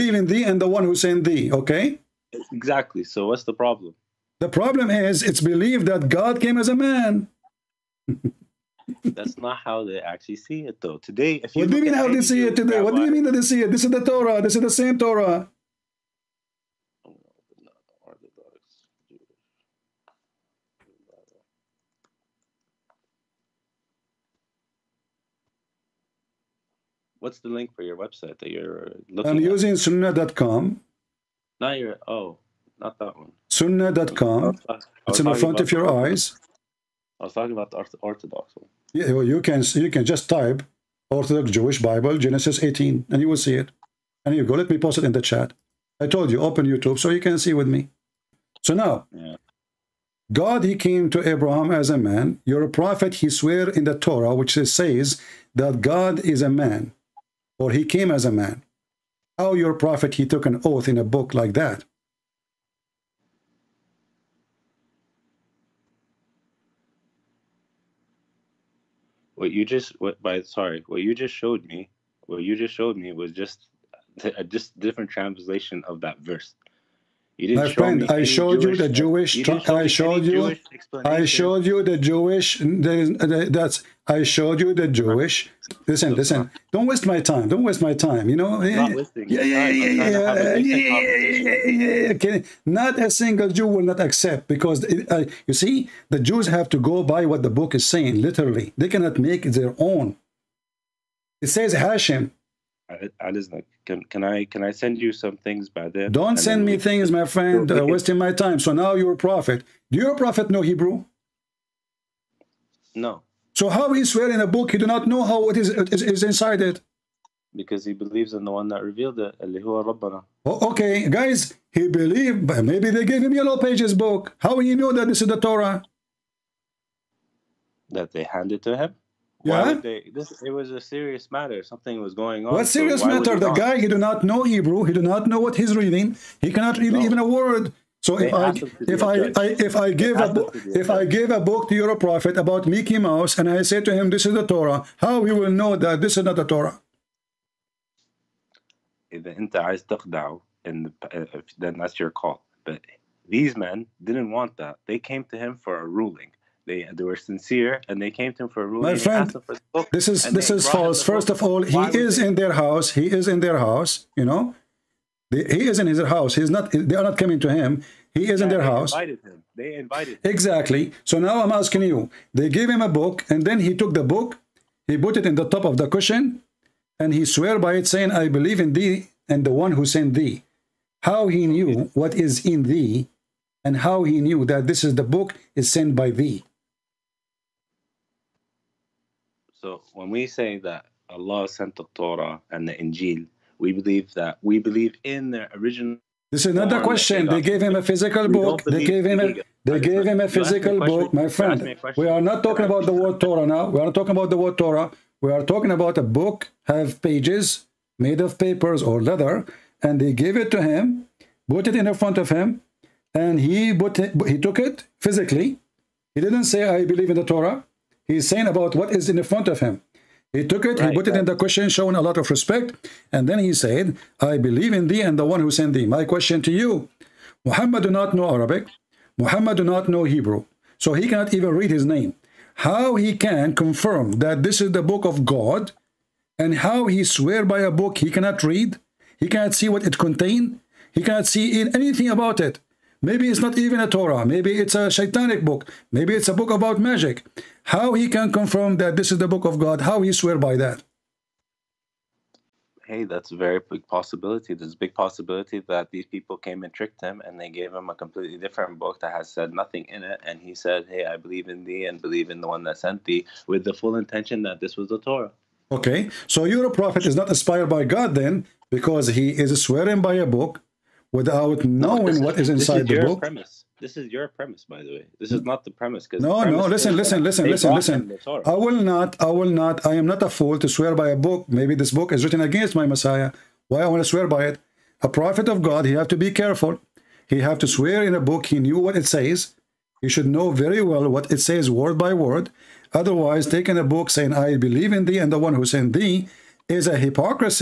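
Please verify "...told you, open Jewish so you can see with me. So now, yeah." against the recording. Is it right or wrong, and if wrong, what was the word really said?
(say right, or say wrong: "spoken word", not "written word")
wrong: "YouTube", not "Jewish".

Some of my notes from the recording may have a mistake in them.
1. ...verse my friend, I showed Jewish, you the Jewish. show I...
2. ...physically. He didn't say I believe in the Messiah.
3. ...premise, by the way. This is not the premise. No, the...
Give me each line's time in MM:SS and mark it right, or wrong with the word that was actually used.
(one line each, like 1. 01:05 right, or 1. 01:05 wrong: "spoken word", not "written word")
1. 01:16 right
2. 03:34 wrong: "Torah", not "Messiah"
3. 04:34 right.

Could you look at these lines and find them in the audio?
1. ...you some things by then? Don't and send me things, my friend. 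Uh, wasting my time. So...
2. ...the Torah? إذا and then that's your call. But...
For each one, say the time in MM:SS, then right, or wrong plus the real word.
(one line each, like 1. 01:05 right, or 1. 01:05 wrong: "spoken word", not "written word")
1. 01:44 right
2. 02:26 right.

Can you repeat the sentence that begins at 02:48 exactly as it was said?
He is yeah, in their house.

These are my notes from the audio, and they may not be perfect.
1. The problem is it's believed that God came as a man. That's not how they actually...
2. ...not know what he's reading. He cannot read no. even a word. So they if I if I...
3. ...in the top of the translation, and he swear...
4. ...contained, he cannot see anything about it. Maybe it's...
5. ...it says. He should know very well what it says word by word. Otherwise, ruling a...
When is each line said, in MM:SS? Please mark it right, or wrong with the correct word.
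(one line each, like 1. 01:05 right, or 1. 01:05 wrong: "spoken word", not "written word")
1. 00:04 right
2. 02:15 right
3. 02:55 wrong: "cushion", not "translation"
4. 03:59 right
5. 04:48 wrong: "taking", not "ruling".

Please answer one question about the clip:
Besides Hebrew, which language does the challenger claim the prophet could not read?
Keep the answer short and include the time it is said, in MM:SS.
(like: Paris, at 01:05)
Arabic, at 03:48.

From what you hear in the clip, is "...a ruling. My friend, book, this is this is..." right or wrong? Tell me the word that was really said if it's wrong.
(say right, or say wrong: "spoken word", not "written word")
right.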